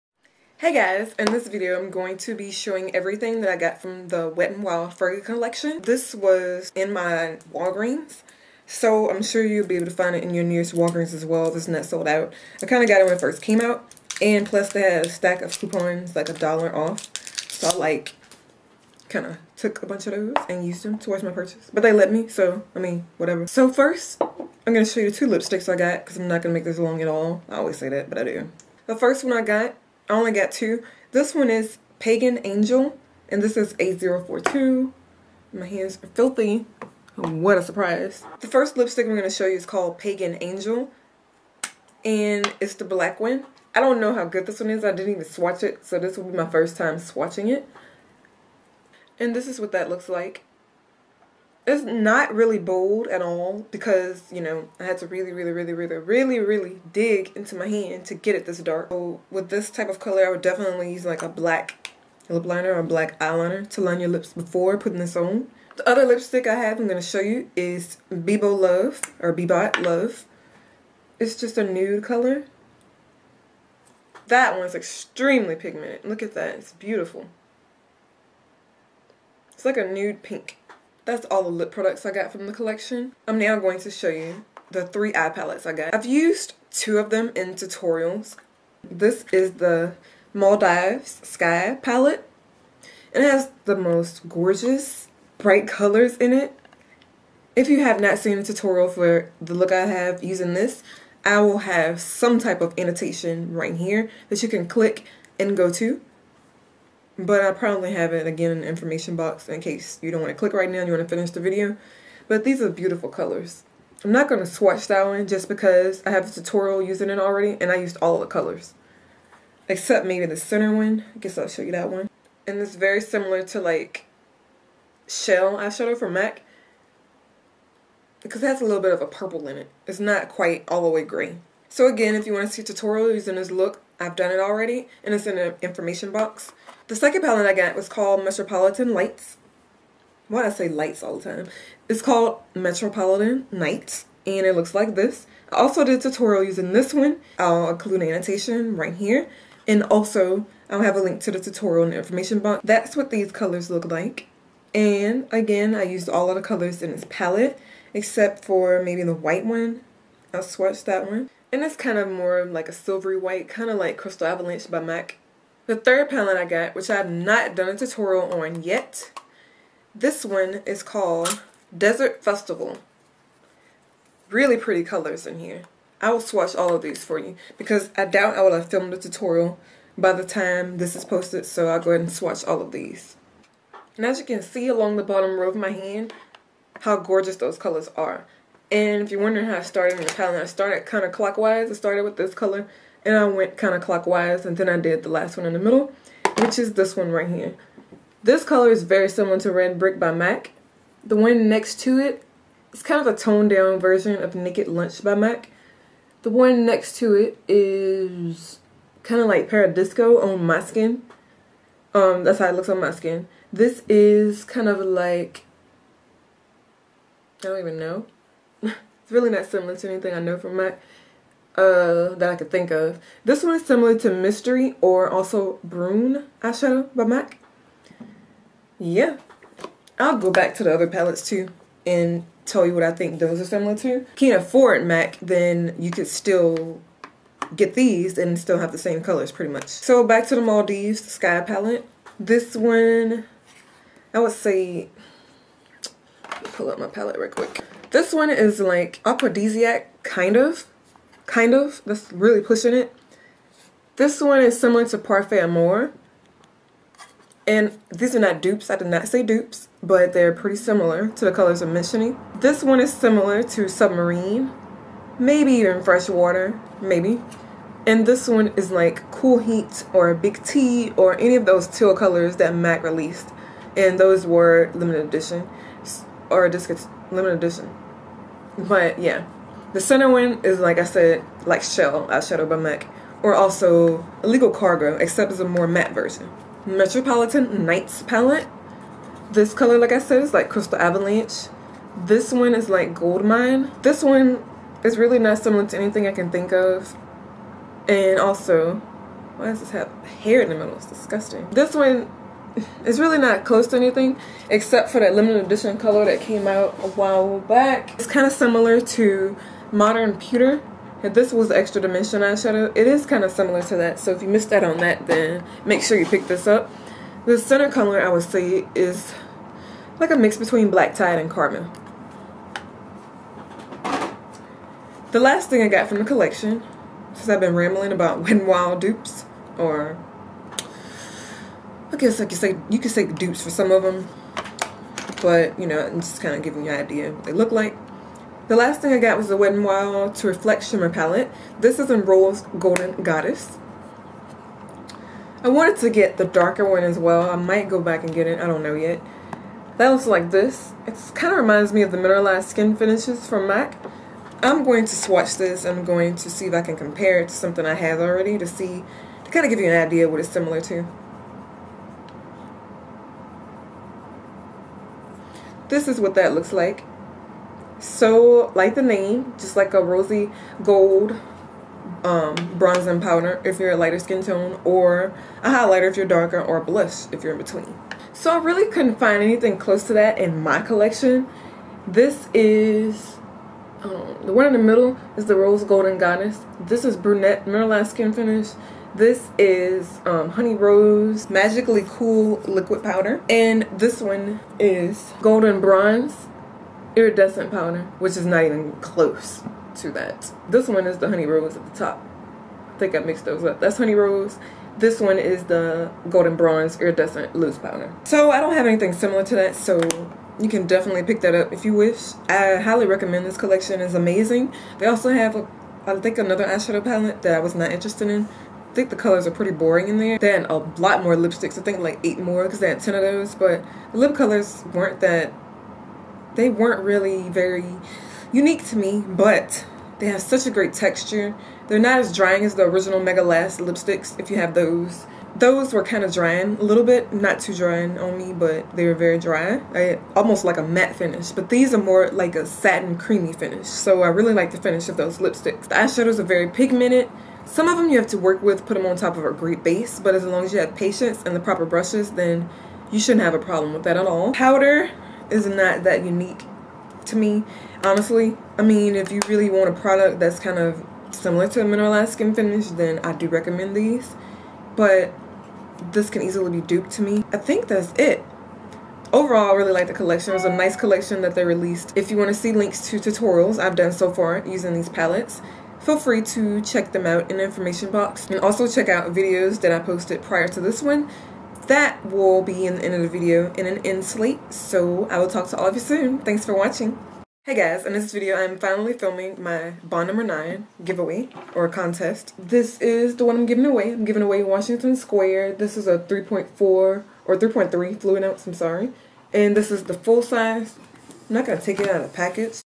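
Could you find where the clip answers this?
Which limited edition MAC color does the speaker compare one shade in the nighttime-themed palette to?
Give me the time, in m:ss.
5:09.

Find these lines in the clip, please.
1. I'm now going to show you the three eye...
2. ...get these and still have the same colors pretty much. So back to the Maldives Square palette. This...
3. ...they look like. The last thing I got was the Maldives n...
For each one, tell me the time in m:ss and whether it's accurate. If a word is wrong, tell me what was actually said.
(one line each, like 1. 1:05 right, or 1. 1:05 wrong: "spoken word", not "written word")
1. 1:23 right
2. 3:57 wrong: "Sky", not "Square"
3. 5:37 wrong: "Wet", not "Maldives".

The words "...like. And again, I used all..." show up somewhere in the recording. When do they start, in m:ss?
2:33.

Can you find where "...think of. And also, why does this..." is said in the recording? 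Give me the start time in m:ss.
4:56.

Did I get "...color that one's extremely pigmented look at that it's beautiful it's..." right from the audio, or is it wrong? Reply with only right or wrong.
right.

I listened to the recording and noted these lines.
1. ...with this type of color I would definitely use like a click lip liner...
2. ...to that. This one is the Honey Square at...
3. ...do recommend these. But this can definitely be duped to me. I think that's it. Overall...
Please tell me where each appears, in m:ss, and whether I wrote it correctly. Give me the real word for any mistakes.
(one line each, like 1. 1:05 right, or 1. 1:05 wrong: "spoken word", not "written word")
1. 0:59 wrong: "black", not "click"
2. 6:39 wrong: "Rose", not "Square"
3. 7:43 wrong: "easily", not "definitely".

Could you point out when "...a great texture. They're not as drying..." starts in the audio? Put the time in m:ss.
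7:10.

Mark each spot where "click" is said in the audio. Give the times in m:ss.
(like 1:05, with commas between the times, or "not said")
1:44, 1:50.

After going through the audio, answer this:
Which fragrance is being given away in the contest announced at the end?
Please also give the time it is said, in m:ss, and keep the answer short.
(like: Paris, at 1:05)
Washington Square, at 8:14.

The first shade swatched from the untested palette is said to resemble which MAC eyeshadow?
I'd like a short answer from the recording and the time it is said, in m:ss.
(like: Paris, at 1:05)
Red Brick, at 3:19.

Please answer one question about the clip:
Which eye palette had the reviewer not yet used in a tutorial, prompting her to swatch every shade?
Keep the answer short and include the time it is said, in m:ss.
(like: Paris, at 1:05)
Desert Festival, at 2:51.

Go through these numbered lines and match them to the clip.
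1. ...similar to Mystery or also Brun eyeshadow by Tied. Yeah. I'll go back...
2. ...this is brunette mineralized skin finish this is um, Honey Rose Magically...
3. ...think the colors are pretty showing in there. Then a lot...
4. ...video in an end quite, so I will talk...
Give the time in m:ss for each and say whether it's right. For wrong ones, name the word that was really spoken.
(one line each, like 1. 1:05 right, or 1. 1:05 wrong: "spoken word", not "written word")
1. 3:43 wrong: "MAC", not "Tied"
2. 6:26 right
3. 6:58 wrong: "boring", not "showing"
4. 8:03 wrong: "slate", not "quite".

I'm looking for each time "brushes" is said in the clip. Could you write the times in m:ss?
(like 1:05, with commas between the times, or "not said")
7:31.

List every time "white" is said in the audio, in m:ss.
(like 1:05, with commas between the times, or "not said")
2:39, 2:43.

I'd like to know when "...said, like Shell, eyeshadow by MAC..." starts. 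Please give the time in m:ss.
4:40.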